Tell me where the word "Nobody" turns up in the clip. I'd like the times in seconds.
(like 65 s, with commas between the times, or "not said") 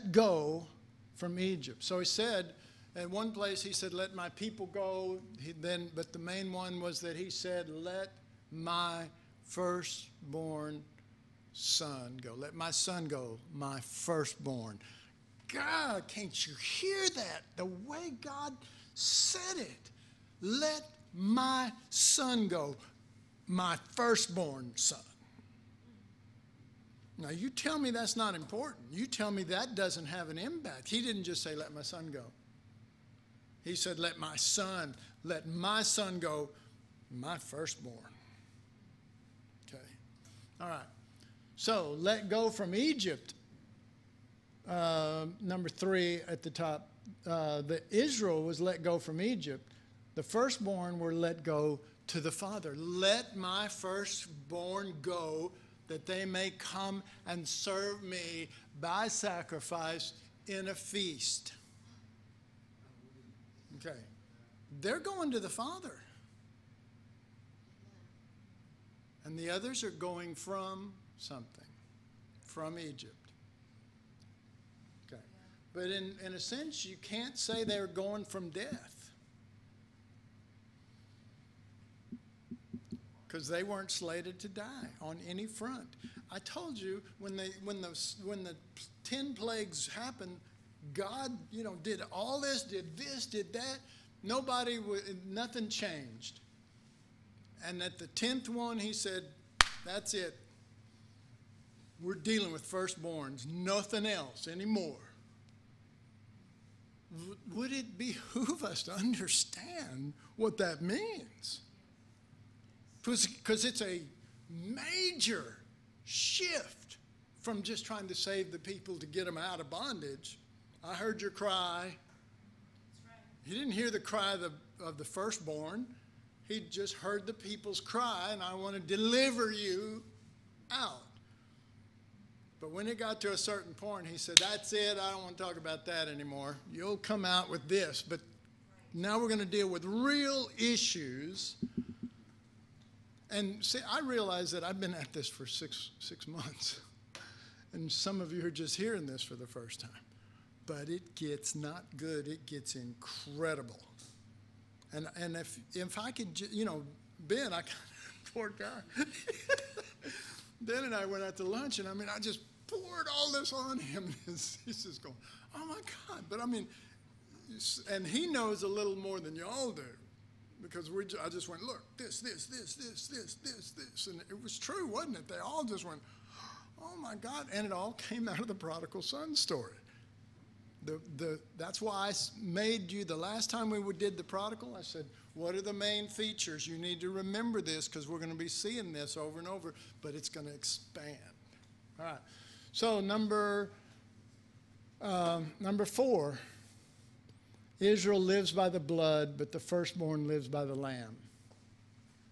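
94 s.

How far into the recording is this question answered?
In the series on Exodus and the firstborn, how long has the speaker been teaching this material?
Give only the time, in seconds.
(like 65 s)
145 s.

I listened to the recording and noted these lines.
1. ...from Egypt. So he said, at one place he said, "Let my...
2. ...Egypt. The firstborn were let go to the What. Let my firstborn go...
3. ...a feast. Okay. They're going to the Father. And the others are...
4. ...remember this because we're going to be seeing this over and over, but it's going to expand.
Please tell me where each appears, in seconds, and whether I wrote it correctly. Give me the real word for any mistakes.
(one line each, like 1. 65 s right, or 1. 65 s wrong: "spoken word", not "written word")
1. 1 s right
2. 49 s wrong: "Father", not "What"
3. 60 s right
4. 187 s right.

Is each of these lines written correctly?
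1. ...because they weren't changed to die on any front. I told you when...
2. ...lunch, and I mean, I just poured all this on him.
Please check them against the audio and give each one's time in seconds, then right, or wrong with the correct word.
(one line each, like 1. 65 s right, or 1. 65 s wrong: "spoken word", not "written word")
1. 83 s wrong: "slated", not "changed"
2. 161 s right.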